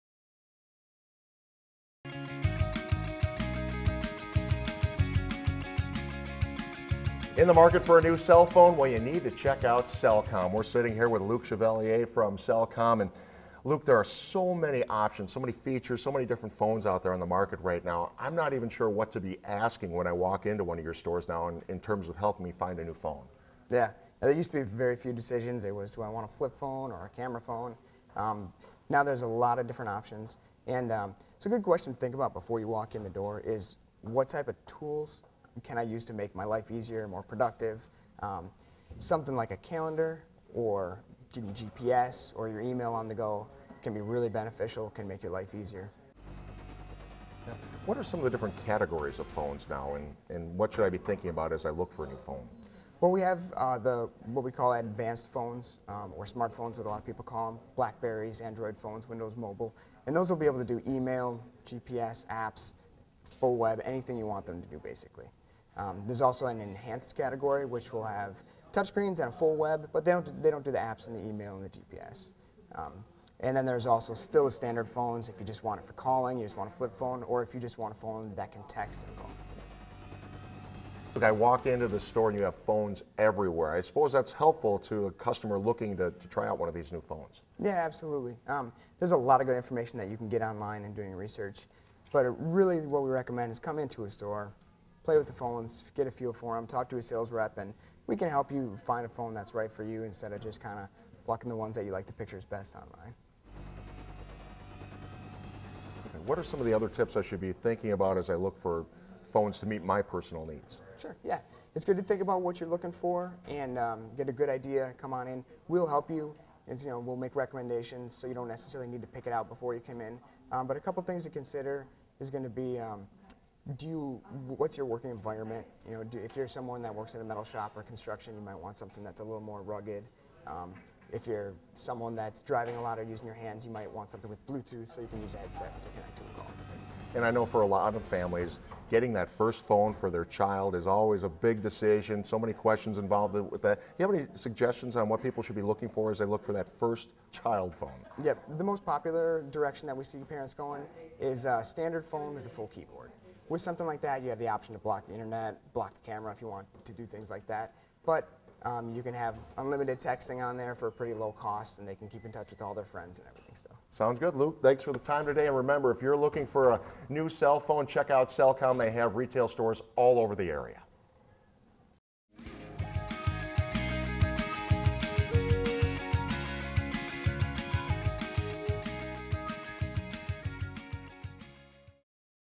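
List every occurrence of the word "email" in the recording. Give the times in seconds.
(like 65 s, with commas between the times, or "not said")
42 s, 60 s, 71 s.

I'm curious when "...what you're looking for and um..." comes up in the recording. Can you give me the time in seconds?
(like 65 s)
112 s.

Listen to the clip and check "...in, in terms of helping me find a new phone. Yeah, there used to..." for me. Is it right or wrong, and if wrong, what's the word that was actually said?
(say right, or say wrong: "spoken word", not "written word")
right.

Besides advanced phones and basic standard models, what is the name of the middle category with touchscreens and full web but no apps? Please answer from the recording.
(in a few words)
enhanced.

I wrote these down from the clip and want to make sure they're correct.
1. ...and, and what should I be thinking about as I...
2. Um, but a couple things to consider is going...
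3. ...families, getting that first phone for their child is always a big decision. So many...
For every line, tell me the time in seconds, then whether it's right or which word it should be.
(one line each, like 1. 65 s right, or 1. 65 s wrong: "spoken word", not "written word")
1. 49 s right
2. 120 s right
3. 138 s right.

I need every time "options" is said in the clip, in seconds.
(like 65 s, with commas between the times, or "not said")
14 s, 29 s, 154 s.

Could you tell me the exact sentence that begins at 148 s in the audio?
Yep, the most popular direction that we see parents going is a uh, standard phone with a full keyboard.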